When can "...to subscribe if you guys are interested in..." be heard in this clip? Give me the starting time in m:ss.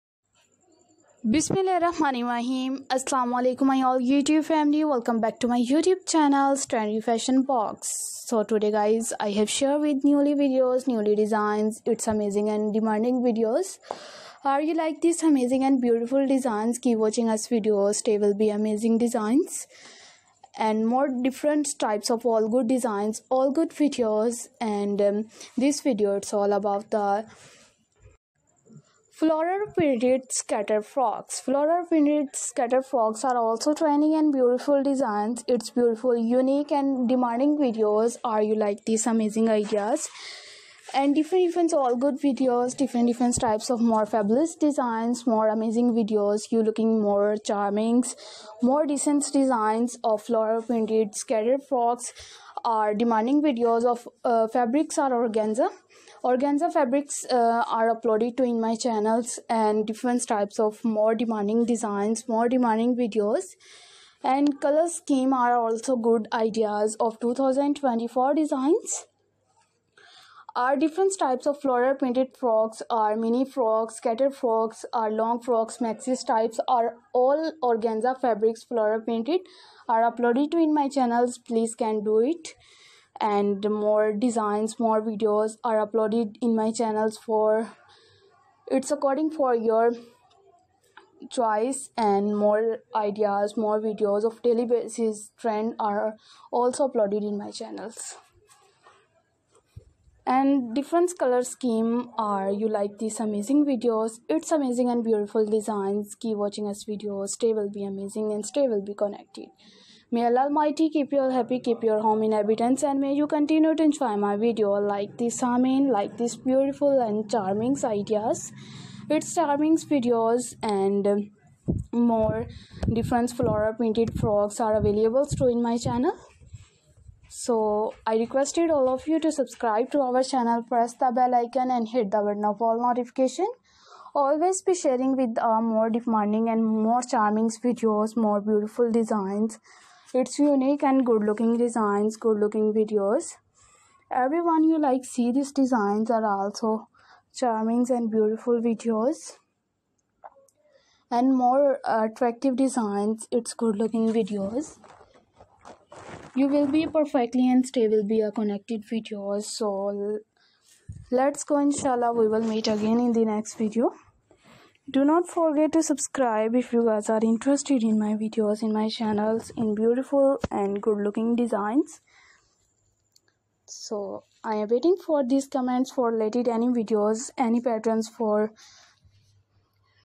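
2:45.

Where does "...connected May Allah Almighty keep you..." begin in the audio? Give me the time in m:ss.
1:48.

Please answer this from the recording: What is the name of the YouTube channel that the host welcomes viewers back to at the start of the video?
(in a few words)
Trendy Fashion Box.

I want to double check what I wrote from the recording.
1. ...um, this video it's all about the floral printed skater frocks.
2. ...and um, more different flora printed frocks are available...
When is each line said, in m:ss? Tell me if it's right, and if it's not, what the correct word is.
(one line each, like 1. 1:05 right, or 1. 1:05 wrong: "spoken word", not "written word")
1. 0:25 right
2. 2:00 right.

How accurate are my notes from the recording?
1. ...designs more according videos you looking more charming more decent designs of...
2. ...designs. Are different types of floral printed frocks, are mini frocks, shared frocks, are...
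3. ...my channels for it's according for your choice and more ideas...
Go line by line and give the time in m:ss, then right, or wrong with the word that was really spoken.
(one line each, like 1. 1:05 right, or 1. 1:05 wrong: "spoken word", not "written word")
1. 0:44 wrong: "amazing", not "according"
2. 1:08 wrong: "scattered", not "shared"
3. 1:26 right.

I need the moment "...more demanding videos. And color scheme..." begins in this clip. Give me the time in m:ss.
1:02.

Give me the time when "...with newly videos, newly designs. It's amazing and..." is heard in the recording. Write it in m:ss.
0:09.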